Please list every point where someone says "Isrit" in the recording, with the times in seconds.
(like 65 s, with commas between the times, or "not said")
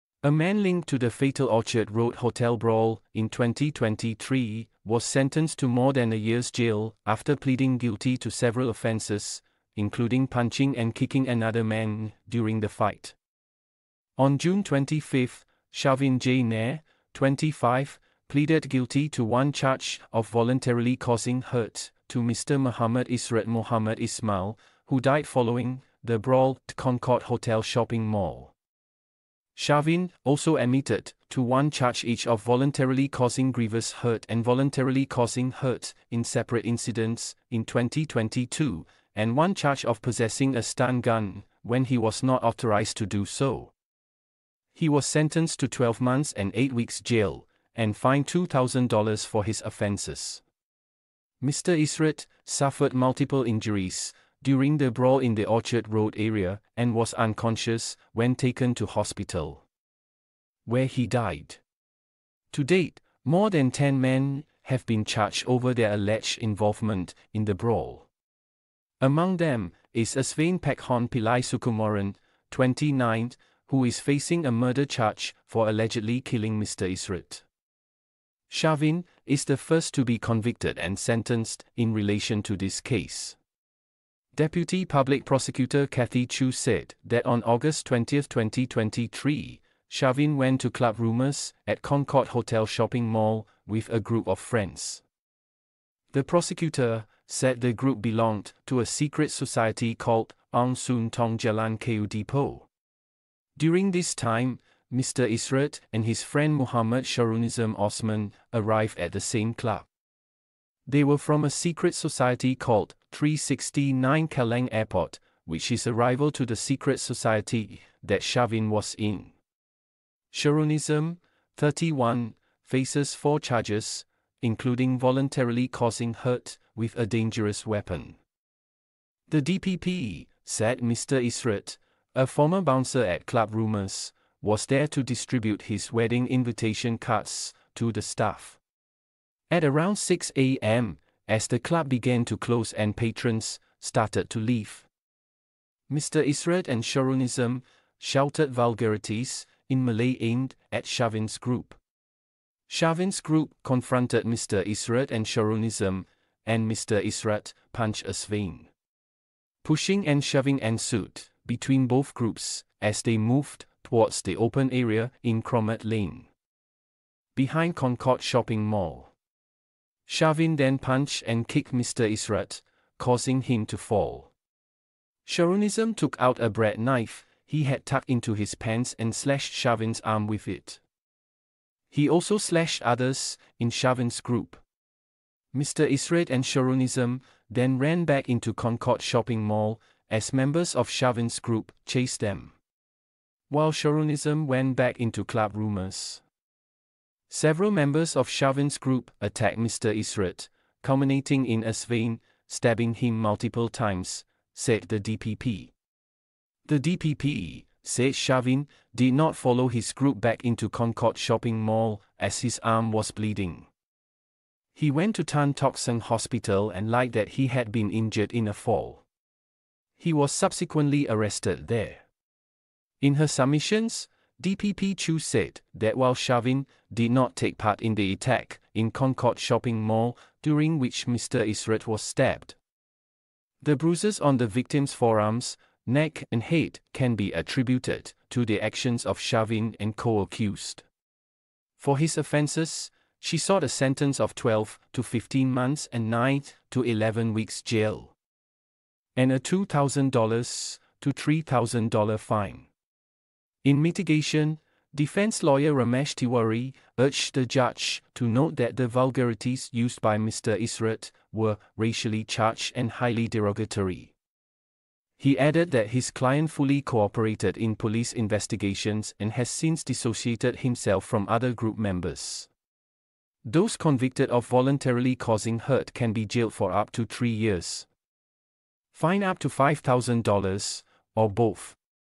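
76 s, 199 s.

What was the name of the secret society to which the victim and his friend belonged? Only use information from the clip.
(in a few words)
369 Kallang Airport.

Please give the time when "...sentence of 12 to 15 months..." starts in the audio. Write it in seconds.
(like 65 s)
243 s.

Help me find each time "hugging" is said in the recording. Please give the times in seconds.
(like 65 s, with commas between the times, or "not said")
not said.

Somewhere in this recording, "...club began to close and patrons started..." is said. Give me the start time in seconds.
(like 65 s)
141 s.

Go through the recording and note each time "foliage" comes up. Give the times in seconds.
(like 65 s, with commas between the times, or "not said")
not said.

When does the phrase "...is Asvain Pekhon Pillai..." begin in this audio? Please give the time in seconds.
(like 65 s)
69 s.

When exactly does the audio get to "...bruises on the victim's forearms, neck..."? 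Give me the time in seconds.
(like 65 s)
233 s.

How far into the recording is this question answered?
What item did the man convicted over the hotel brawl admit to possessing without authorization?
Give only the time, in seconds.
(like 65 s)
40 s.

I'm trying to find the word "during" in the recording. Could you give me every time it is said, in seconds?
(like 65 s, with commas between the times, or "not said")
12 s, 54 s, 103 s, 230 s.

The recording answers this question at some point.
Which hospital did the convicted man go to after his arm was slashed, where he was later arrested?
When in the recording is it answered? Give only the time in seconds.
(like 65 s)
215 s.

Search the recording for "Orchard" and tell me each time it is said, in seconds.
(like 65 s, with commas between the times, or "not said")
1 s, 55 s.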